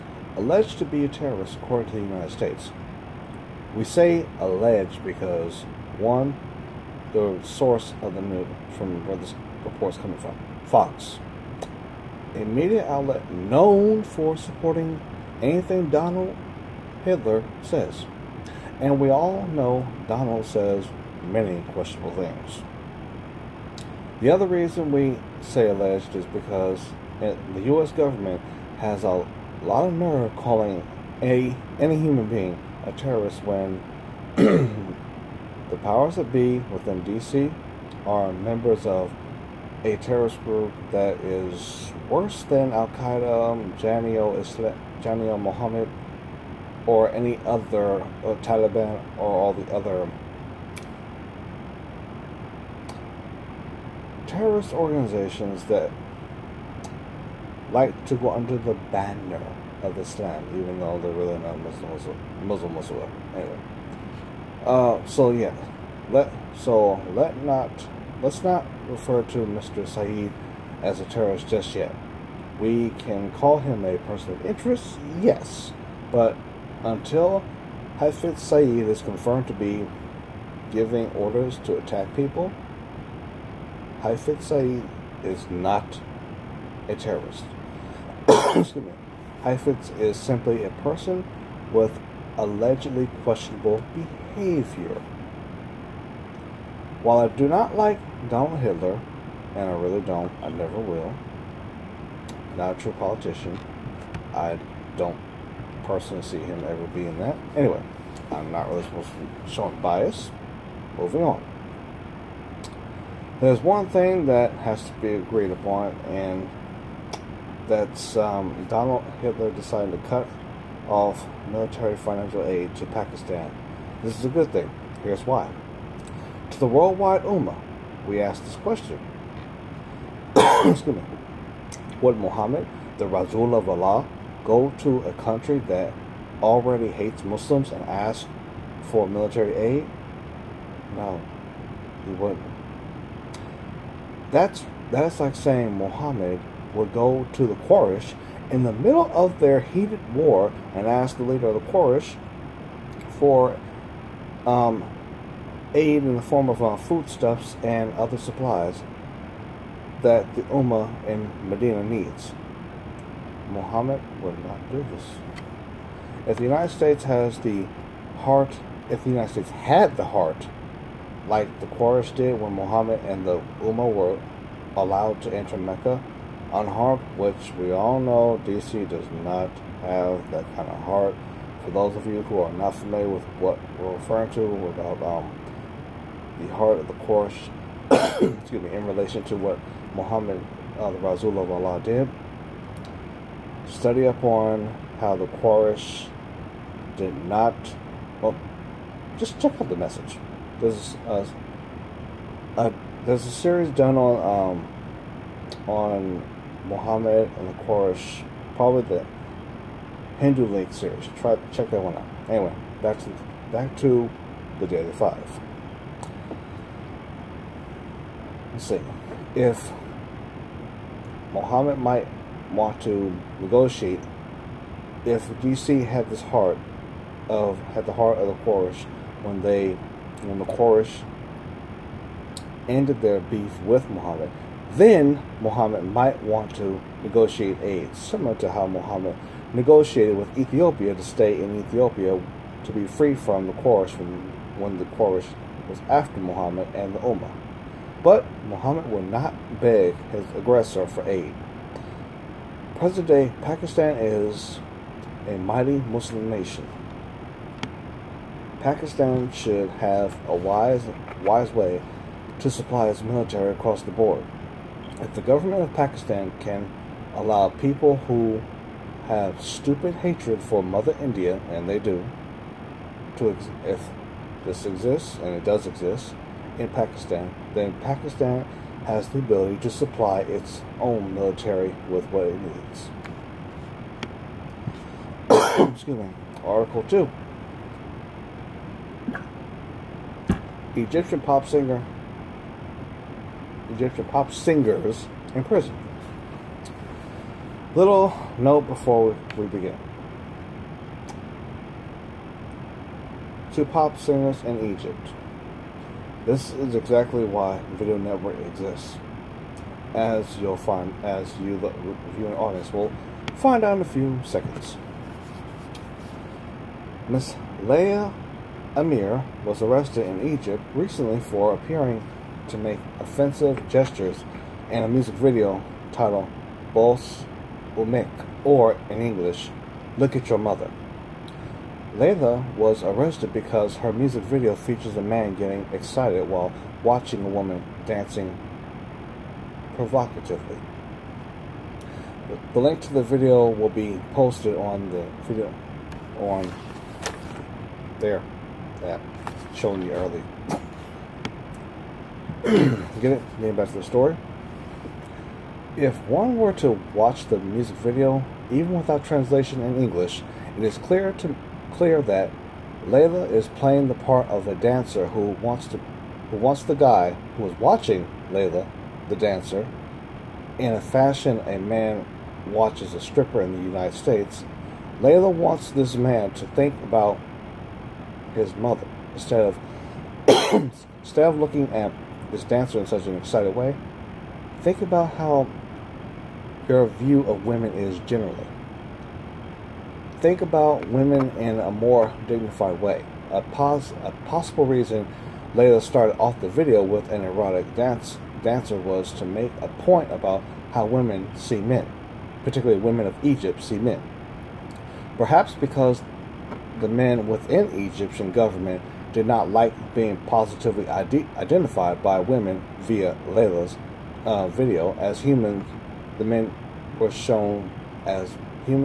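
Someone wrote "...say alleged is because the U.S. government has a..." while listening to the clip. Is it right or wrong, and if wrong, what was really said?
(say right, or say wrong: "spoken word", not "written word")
right.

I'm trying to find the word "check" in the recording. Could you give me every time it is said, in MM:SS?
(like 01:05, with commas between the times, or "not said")
03:19, 03:31.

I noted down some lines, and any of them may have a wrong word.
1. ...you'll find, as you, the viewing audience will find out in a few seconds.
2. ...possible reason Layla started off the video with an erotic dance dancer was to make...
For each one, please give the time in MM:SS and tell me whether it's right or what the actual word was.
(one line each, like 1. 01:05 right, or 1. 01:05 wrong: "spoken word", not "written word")
1. 05:10 right
2. 06:34 right.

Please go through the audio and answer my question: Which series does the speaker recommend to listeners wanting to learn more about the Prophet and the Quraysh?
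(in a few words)
Hindu League series.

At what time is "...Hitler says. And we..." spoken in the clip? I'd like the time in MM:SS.
00:17.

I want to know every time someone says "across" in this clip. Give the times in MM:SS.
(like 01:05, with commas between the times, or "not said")
04:23.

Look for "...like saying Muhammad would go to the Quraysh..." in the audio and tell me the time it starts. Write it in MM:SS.
02:25.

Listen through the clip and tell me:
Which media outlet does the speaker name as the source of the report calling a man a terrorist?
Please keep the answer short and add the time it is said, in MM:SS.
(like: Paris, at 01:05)
Fox, at 00:10.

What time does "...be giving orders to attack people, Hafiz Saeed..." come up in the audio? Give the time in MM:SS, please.
01:19.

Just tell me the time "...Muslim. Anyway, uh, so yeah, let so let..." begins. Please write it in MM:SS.
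01:02.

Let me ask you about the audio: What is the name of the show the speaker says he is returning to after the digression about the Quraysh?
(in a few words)
Daily Five.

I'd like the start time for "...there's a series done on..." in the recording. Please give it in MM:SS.
03:23.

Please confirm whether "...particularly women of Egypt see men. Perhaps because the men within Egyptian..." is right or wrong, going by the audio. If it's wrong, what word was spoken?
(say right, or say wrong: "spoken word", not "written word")
right.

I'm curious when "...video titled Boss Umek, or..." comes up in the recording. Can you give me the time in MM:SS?
05:25.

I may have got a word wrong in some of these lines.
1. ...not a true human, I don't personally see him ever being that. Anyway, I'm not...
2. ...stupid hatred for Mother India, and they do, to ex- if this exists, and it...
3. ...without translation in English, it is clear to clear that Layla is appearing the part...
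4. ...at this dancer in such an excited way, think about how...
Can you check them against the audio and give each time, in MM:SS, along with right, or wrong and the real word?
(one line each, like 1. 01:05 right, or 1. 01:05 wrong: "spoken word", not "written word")
1. 01:42 wrong: "politician", not "human"
2. 04:29 right
3. 05:58 wrong: "playing", not "appearing"
4. 06:21 right.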